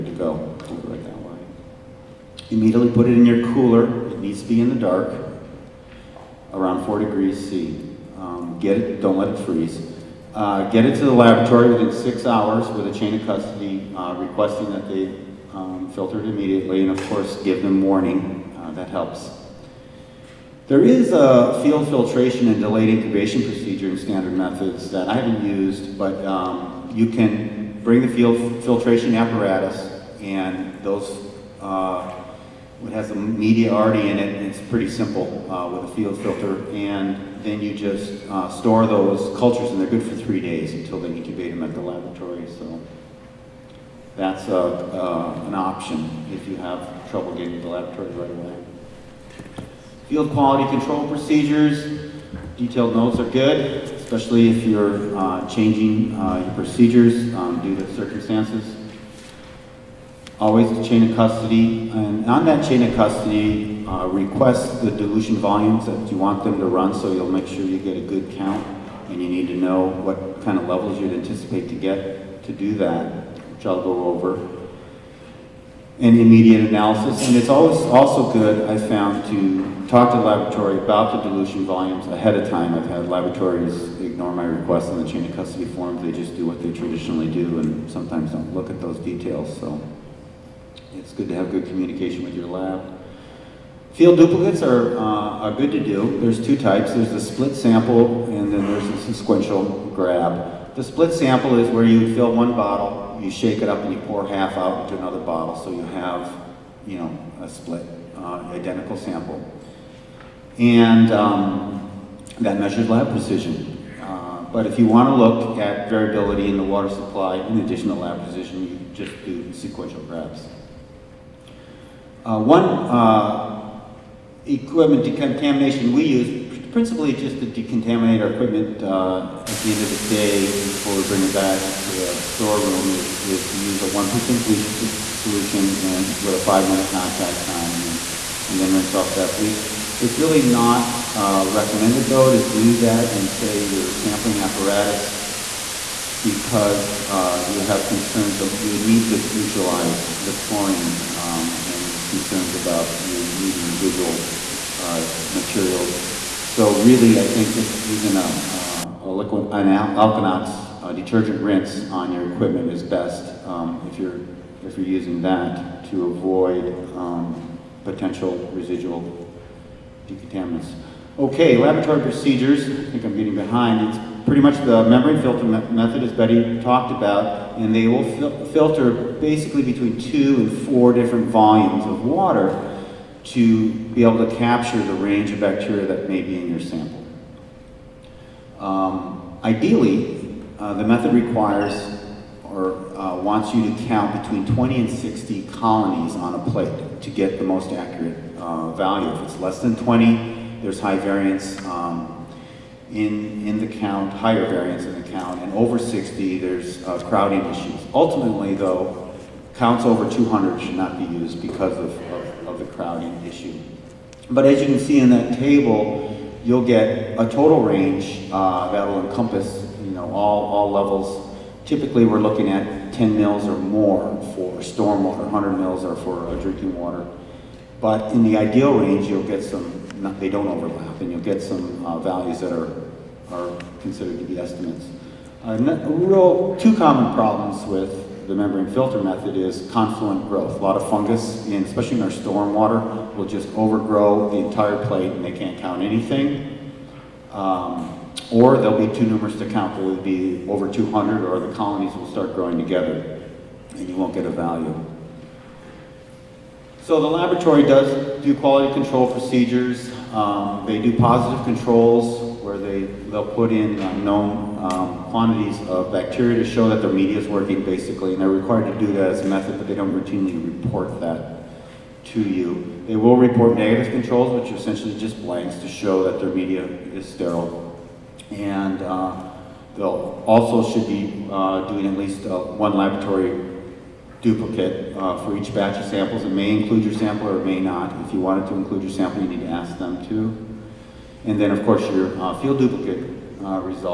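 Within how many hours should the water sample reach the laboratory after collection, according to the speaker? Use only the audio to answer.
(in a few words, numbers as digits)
6 hours.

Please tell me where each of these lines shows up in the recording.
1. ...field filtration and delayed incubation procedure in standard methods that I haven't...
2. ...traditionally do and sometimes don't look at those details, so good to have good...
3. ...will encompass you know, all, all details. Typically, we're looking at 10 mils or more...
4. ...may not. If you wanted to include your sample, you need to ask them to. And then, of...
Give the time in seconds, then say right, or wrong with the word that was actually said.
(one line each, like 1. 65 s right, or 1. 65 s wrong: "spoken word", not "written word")
1. 21 s right
2. 86 s right
3. 218 s wrong: "levels", not "details"
4. 287 s right.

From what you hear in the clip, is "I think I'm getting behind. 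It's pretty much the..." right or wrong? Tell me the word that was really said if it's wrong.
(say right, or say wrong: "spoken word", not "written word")
right.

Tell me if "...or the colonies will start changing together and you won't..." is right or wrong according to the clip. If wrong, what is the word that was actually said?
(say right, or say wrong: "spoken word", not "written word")
wrong: "growing", not "changing".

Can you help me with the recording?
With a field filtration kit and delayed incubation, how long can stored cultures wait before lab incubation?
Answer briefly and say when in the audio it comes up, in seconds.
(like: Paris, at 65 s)
3 days, at 40 s.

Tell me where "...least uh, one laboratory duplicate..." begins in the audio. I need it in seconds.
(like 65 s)
281 s.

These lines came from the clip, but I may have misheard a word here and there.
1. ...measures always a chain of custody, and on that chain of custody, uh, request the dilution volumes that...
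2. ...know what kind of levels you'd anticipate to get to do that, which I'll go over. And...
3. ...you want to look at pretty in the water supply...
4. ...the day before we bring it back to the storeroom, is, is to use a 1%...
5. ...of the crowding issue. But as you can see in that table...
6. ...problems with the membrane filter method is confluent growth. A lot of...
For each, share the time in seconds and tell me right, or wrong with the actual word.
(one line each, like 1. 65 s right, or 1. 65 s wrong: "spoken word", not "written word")
1. 57 s wrong: "circumstances", not "measures"
2. 69 s right
3. 114 s wrong: "variability", not "pretty"
4. 129 s right
5. 212 s right
6. 237 s right.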